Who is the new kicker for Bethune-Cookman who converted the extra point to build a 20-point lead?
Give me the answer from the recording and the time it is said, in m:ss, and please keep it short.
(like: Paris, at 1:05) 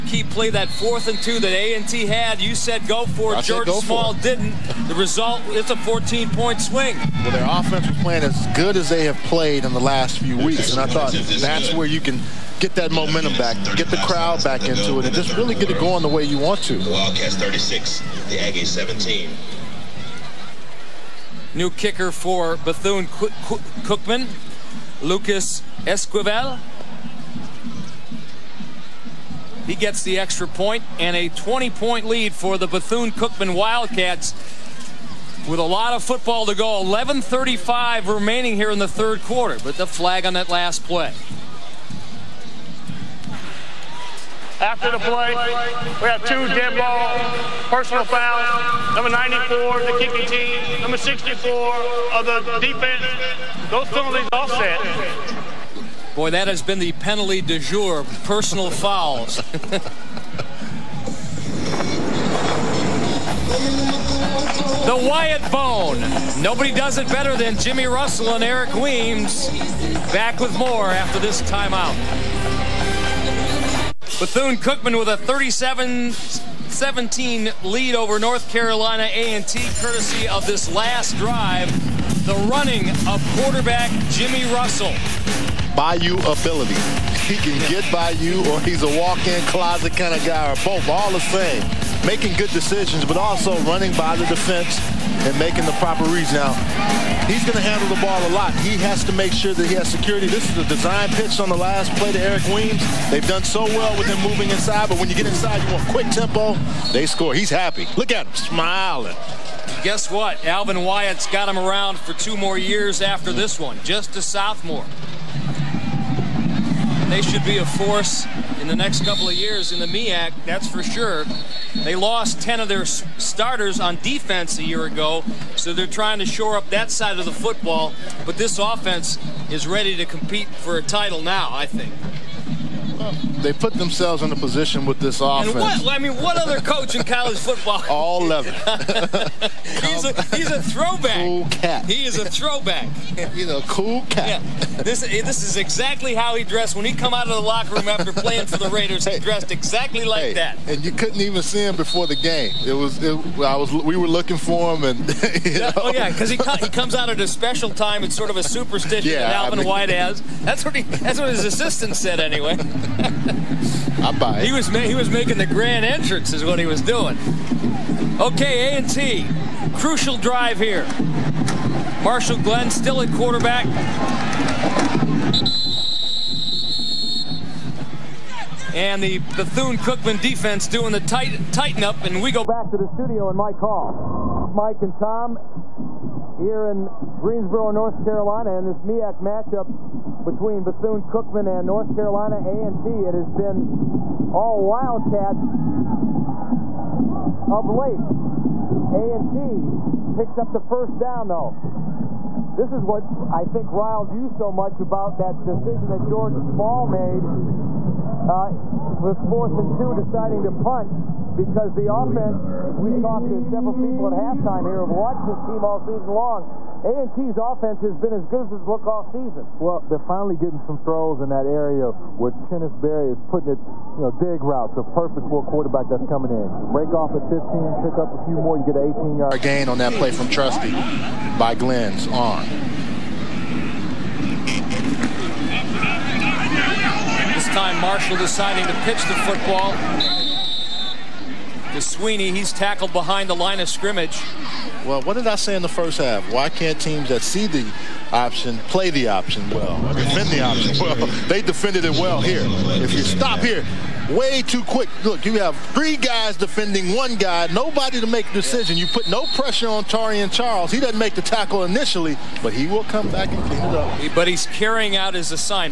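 Lucas Esquivel, at 0:25.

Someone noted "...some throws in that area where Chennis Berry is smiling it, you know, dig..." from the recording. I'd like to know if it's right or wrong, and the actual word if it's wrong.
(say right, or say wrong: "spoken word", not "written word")
wrong: "putting", not "smiling".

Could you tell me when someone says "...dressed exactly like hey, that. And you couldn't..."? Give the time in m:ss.
2:29.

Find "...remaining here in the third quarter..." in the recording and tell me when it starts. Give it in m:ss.
0:38.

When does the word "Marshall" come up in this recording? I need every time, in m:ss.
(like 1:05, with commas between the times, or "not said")
2:52, 3:57.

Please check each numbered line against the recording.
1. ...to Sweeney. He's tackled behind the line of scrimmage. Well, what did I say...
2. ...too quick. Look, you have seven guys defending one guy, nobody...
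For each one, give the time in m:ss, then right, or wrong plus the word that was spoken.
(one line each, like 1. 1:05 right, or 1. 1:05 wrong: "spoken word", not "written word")
1. 4:01 right
2. 4:14 wrong: "three", not "seven".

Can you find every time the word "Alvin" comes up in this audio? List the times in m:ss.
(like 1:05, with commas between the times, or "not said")
1:50, 2:39.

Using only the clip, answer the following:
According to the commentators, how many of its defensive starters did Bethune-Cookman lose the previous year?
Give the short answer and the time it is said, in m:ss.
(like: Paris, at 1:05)
10, at 2:02.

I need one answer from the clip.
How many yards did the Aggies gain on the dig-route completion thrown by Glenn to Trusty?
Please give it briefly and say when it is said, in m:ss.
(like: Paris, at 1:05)
18, at 3:48.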